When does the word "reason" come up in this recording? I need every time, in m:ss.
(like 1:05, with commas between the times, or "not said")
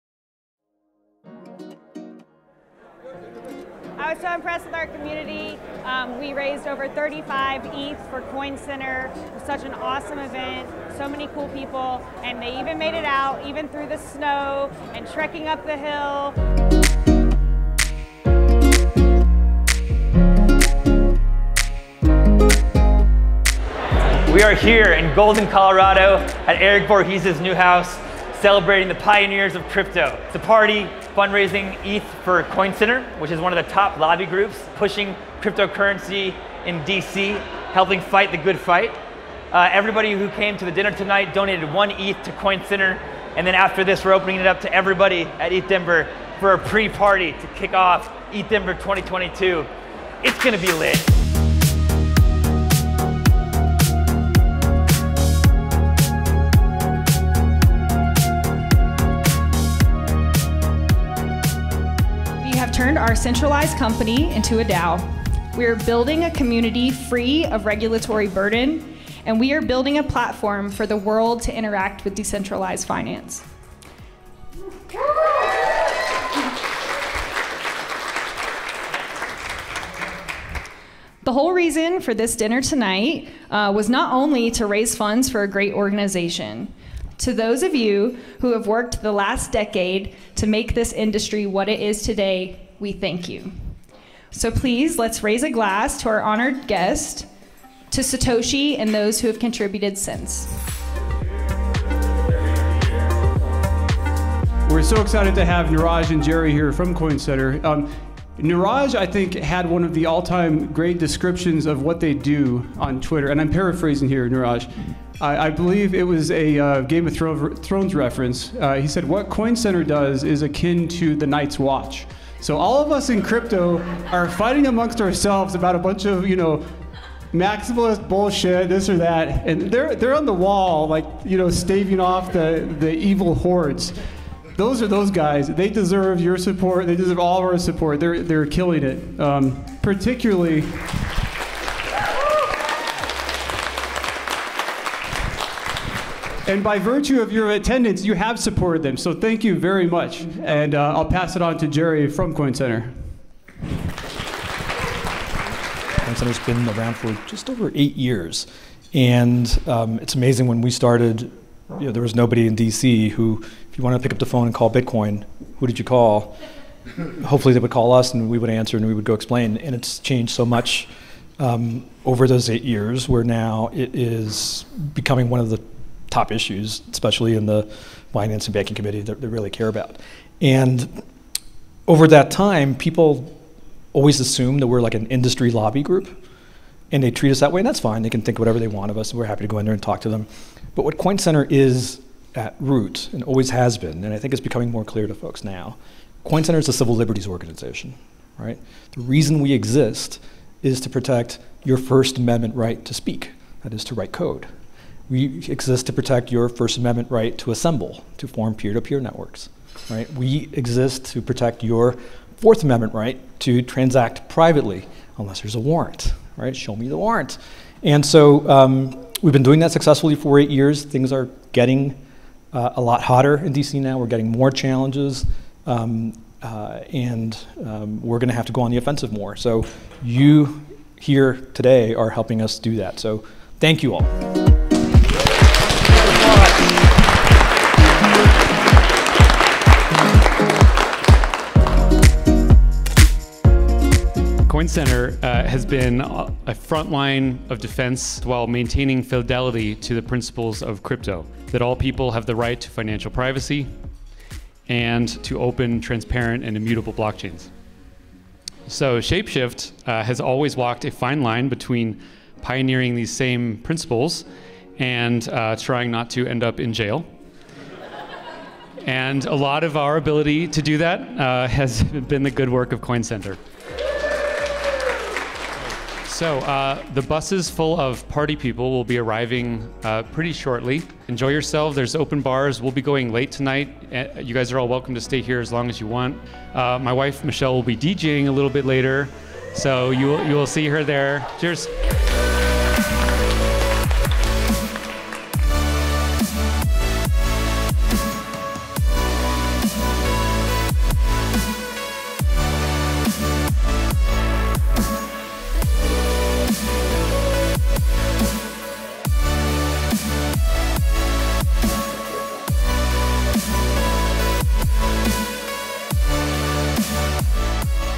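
1:21, 3:19.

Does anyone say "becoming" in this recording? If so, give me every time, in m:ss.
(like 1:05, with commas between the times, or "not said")
2:54, 3:14.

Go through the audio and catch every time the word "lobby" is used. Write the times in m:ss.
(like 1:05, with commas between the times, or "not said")
0:33, 3:05.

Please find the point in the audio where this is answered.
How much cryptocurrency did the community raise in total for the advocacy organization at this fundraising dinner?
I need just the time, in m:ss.
0:06.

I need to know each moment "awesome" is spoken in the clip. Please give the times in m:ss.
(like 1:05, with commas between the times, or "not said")
0:09.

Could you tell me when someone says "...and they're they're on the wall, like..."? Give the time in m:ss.
2:09.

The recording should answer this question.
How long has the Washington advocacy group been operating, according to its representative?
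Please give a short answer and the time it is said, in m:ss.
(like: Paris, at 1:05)
just over 8 years, at 2:37.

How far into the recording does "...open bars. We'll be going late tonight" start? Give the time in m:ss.
4:41.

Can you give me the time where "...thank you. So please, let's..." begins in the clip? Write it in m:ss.
1:32.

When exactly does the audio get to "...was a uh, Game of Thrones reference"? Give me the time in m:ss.
1:56.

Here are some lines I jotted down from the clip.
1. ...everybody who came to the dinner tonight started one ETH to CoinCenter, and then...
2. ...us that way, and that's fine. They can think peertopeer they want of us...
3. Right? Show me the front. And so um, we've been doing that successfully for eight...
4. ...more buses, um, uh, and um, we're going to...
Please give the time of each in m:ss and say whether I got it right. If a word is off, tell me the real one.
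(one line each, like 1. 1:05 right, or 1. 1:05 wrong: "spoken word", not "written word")
1. 0:39 wrong: "donated", not "started"
2. 3:07 wrong: "whatever", not "peertopeer"
3. 3:36 wrong: "warrant", not "front"
4. 3:44 wrong: "challenges", not "buses".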